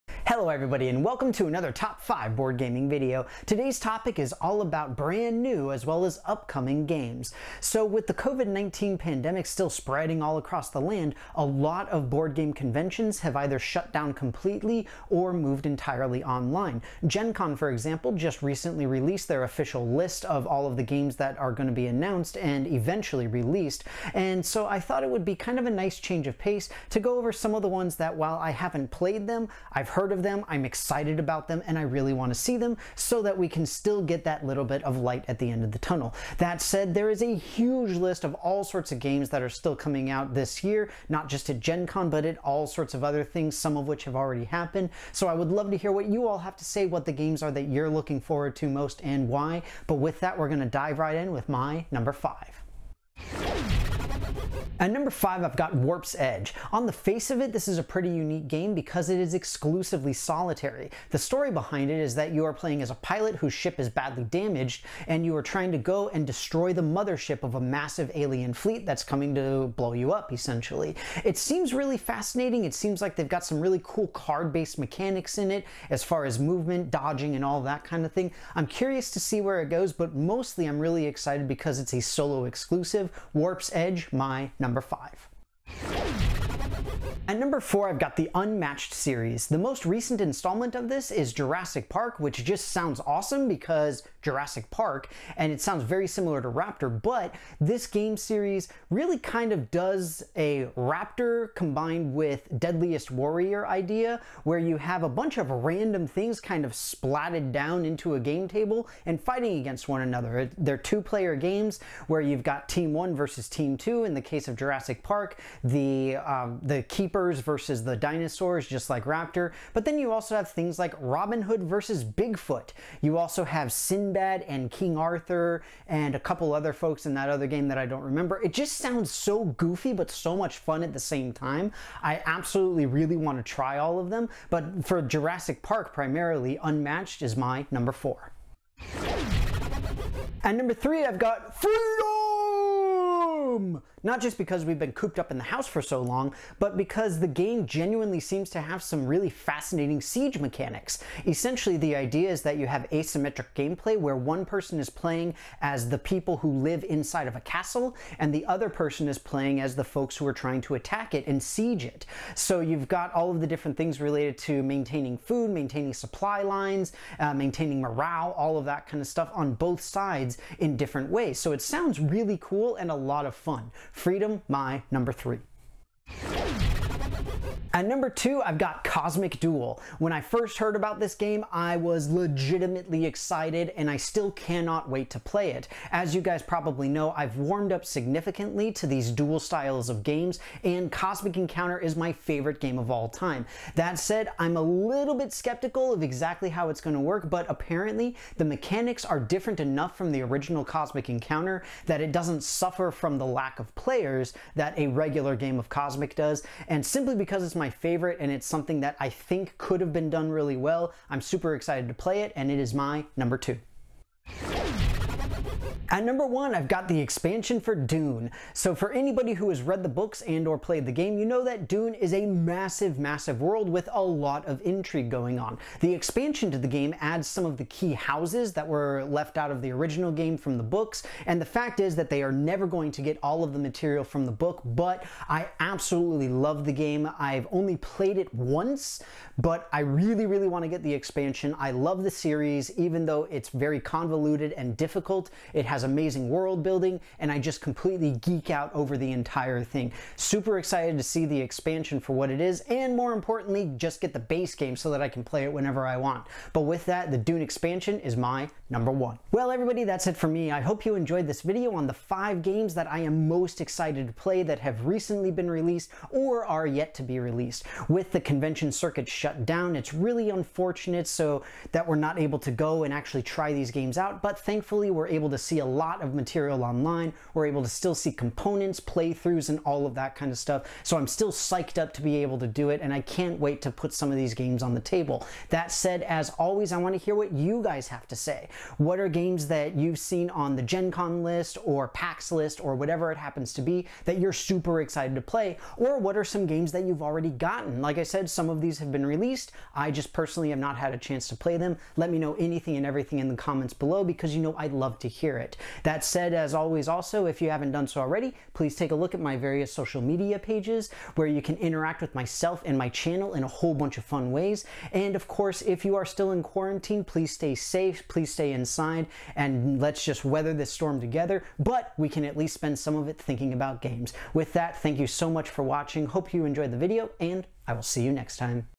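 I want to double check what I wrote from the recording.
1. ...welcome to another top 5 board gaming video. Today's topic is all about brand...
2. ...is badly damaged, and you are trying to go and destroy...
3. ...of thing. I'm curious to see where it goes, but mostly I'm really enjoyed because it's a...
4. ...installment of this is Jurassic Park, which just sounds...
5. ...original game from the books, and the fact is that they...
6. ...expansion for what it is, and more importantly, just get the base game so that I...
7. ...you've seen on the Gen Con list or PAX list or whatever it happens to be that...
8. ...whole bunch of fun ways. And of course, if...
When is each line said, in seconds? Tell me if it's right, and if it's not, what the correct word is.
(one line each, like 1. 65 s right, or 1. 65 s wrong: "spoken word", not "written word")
1. 1 s right
2. 63 s right
3. 78 s wrong: "excited", not "enjoyed"
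4. 90 s right
5. 229 s right
6. 251 s right
7. 289 s right
8. 313 s right.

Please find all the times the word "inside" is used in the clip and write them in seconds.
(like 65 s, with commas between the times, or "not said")
156 s, 318 s.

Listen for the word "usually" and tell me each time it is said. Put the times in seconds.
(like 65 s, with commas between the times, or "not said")
not said.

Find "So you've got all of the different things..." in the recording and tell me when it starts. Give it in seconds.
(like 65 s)
162 s.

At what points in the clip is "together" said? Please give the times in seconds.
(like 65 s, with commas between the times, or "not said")
320 s.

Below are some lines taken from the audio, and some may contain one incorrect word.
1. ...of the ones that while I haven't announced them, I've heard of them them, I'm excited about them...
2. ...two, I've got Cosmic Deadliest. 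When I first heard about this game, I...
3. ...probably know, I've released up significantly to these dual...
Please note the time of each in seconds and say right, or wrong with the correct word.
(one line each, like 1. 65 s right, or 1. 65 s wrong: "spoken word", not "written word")
1. 27 s wrong: "played", not "announced"
2. 178 s wrong: "Duel", not "Deadliest"
3. 186 s wrong: "warmed", not "released".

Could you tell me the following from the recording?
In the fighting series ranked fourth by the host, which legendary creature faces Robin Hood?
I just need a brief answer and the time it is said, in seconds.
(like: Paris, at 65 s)
Bigfoot, at 122 s.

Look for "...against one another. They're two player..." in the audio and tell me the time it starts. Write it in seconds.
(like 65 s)
109 s.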